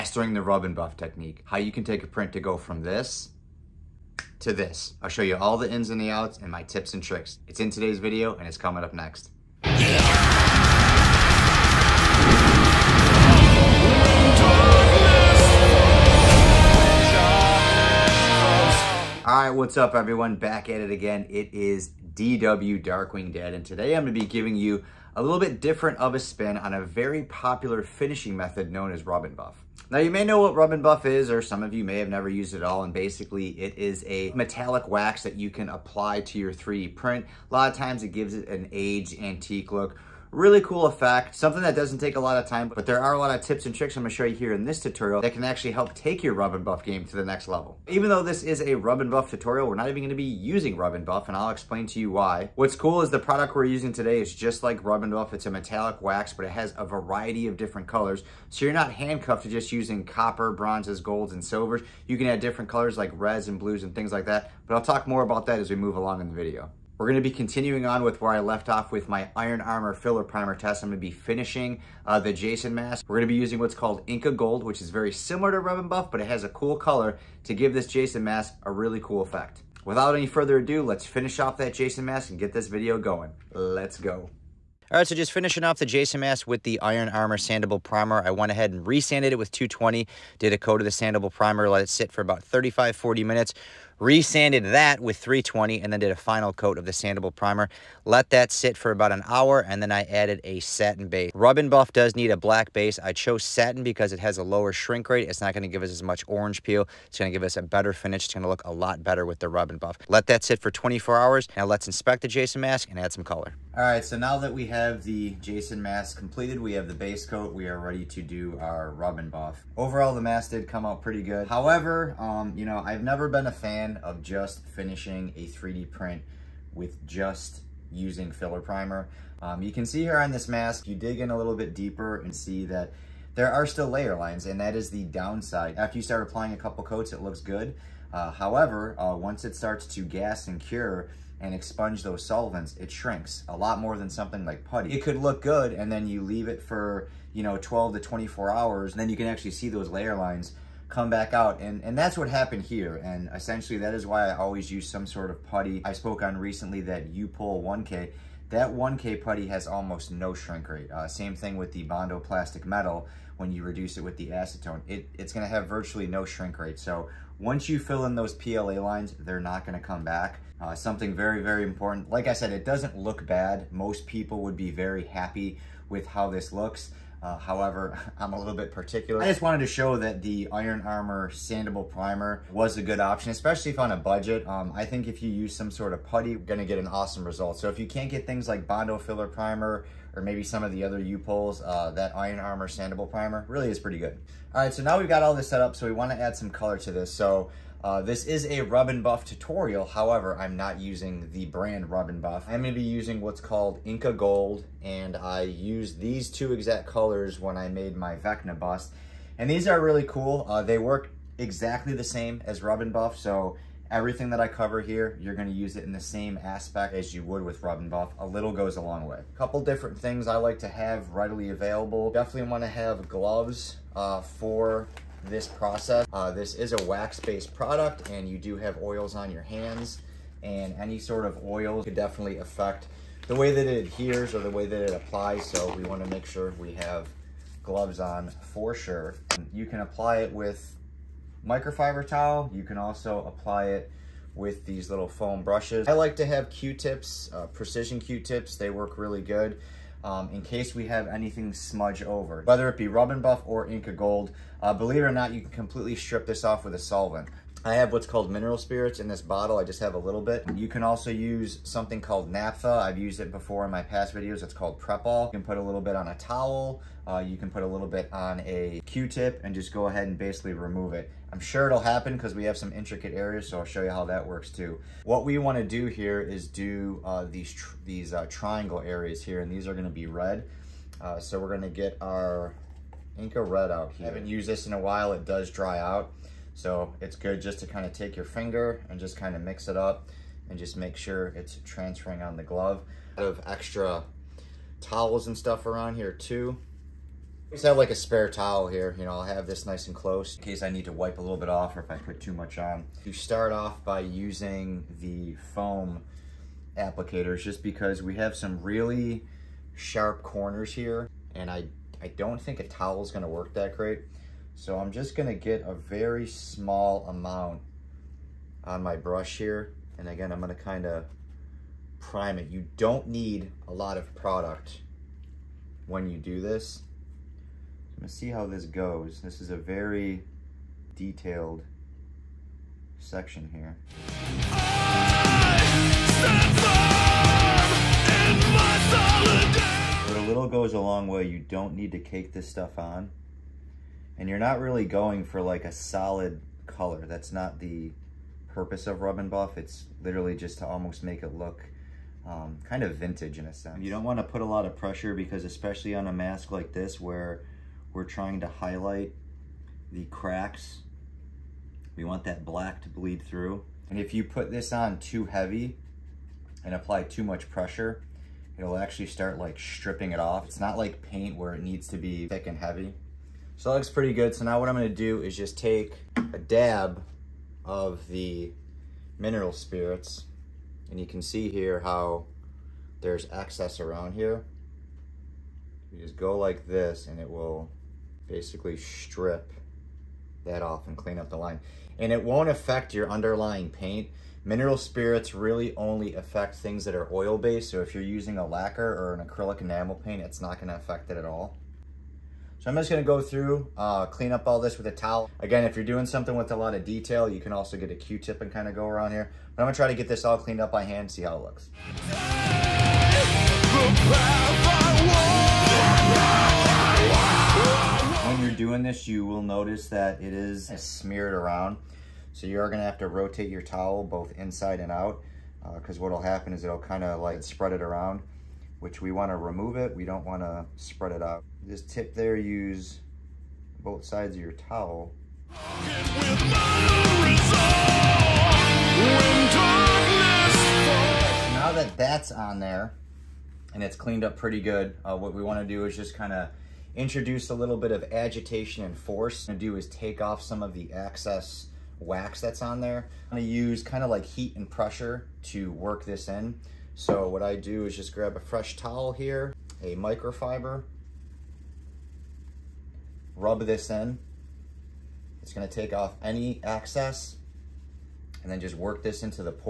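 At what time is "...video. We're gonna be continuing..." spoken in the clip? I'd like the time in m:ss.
1:06.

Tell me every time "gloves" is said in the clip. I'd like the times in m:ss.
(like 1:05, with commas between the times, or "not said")
3:43, 3:57, 4:52.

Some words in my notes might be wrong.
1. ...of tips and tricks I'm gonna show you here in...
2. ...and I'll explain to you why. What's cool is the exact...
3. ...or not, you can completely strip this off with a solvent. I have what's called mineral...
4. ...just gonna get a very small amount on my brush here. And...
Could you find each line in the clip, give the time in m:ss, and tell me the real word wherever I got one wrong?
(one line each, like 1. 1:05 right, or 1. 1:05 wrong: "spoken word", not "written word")
1. 0:43 right
2. 0:51 wrong: "product", not "exact"
3. 4:15 right
4. 5:14 right.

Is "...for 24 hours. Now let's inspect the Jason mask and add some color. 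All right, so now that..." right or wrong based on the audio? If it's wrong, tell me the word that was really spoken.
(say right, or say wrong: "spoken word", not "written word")
right.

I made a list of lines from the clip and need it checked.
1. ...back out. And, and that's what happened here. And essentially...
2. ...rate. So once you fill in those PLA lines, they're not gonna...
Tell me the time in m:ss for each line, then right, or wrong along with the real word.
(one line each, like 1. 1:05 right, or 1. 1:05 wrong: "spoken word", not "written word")
1. 2:31 right
2. 2:46 right.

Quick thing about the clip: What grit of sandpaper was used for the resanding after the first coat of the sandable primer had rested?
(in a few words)
320.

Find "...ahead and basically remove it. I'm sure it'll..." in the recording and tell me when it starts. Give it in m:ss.
4:29.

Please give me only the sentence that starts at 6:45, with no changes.
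Again, if you're doing something with a lot of detail, you can also get a Q-tip and kind of go around here.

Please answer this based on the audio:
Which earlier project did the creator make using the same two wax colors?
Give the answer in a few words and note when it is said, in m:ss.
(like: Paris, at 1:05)
Vecna bust, at 3:28.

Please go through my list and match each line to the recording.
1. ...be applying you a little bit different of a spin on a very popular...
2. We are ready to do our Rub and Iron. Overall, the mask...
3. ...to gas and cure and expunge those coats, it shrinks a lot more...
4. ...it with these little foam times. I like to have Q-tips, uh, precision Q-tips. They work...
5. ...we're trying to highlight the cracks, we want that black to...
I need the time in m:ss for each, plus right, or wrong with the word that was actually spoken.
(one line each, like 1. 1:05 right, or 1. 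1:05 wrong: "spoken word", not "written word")
1. 0:24 wrong: "giving", not "applying"
2. 1:57 wrong: "Buff", not "Iron"
3. 2:19 wrong: "solvents", not "coats"
4. 4:03 wrong: "brushes", not "times"
5. 5:57 right.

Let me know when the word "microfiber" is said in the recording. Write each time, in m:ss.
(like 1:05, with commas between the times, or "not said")
4:01, 7:39.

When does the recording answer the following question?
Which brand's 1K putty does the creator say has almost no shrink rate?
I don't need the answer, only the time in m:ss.
2:37.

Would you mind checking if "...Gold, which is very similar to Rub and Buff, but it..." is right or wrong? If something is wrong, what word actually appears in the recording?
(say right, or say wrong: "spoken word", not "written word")
right.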